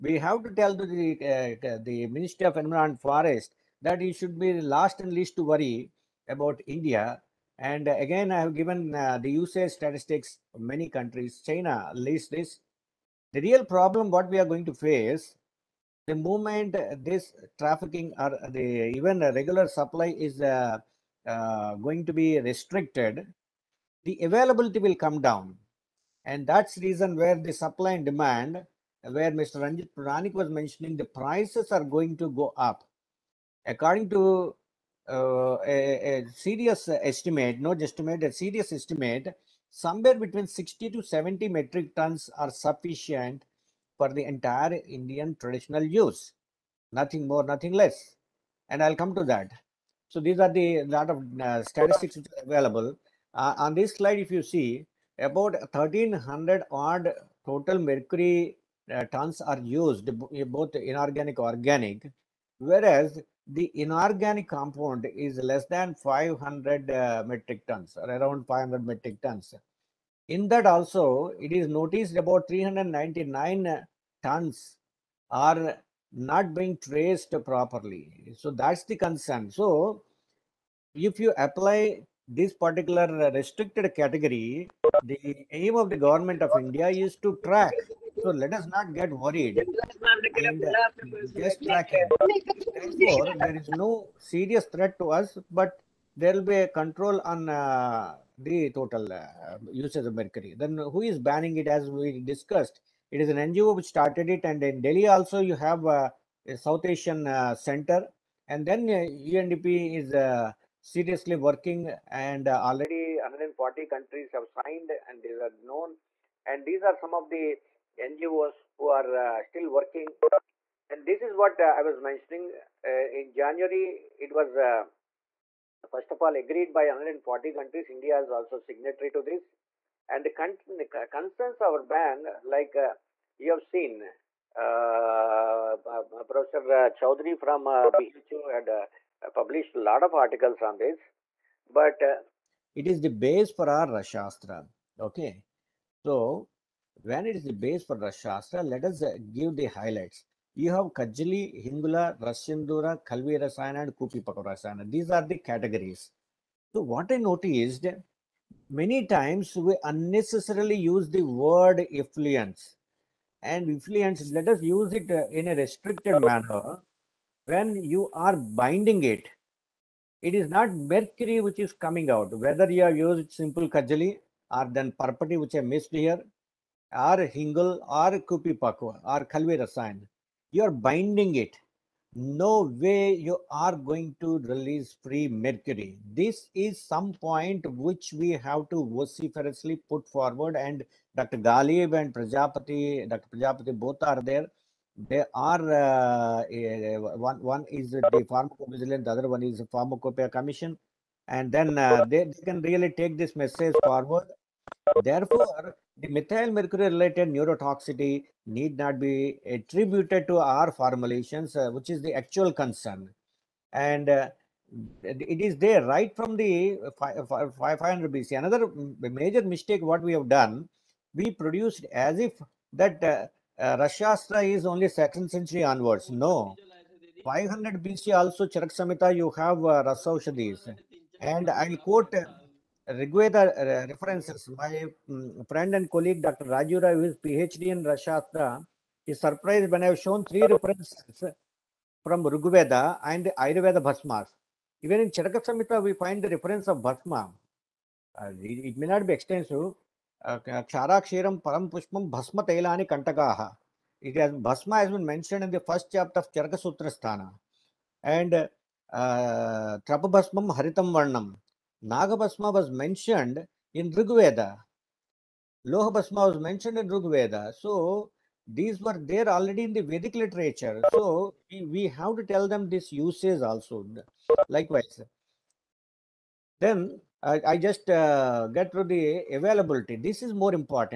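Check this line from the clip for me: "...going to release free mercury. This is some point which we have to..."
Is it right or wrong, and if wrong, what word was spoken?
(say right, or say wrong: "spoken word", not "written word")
right.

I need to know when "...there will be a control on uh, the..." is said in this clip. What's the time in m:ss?
1:36.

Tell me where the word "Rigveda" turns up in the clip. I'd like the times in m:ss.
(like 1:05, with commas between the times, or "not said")
3:52, 4:02.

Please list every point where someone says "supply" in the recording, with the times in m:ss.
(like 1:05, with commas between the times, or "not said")
0:19, 0:27.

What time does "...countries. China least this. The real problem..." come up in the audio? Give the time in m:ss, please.
0:10.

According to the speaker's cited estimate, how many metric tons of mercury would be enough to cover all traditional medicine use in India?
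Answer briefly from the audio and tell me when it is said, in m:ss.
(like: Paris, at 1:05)
60 to 70 metric tons, at 0:40.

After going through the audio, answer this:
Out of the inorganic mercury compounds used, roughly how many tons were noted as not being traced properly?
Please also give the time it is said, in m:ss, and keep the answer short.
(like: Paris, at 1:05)
399 tons, at 1:12.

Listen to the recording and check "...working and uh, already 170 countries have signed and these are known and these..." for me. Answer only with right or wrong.
wrong.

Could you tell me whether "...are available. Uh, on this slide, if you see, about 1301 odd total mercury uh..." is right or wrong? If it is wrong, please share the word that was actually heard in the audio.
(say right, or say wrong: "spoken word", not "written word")
wrong: "1300", not "1301".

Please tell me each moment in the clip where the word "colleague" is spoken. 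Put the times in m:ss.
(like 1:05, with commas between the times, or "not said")
3:55.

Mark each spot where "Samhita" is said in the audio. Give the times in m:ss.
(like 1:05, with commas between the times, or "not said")
3:48, 4:05.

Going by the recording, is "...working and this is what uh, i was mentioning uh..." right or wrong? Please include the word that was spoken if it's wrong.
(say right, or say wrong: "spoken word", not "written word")
right.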